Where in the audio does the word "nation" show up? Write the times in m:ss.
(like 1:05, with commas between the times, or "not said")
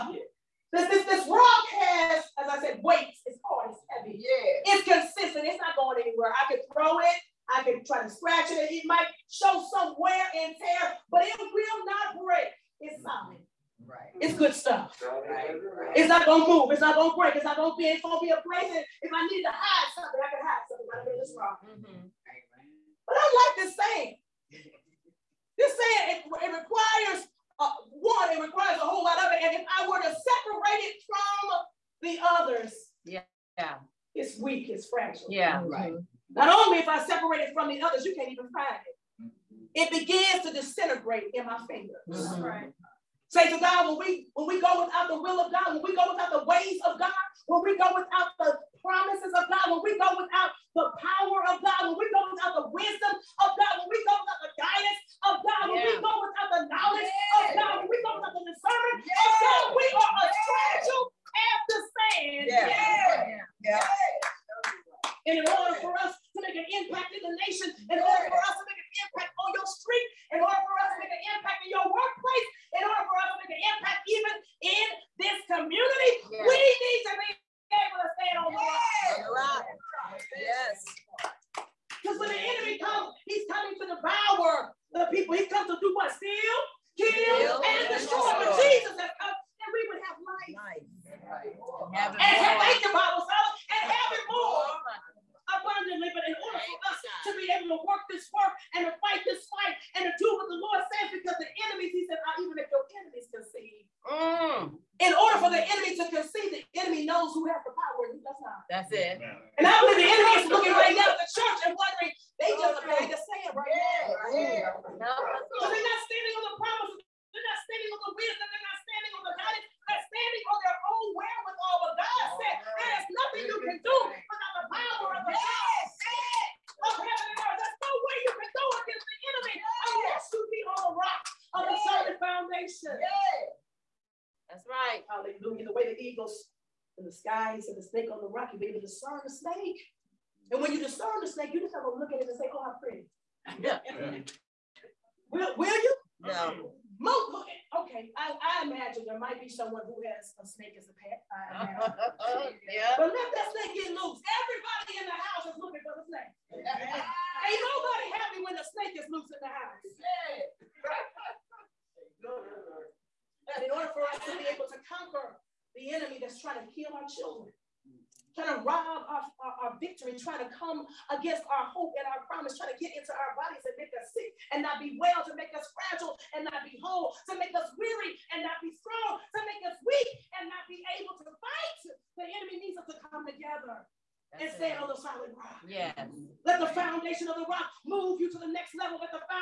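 1:07.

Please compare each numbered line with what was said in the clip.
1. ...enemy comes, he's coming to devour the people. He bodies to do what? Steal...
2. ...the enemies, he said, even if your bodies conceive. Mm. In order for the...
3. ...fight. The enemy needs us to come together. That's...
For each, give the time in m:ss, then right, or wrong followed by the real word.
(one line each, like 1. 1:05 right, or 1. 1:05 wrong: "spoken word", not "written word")
1. 1:22 wrong: "comes", not "bodies"
2. 1:41 wrong: "enemies", not "bodies"
3. 3:01 right.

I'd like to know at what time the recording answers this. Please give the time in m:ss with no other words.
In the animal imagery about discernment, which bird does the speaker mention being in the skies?
2:16.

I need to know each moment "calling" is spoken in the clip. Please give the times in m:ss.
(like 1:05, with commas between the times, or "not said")
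not said.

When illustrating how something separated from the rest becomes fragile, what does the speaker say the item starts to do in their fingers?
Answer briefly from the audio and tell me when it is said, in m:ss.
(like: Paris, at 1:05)
Disintegrate, at 0:40.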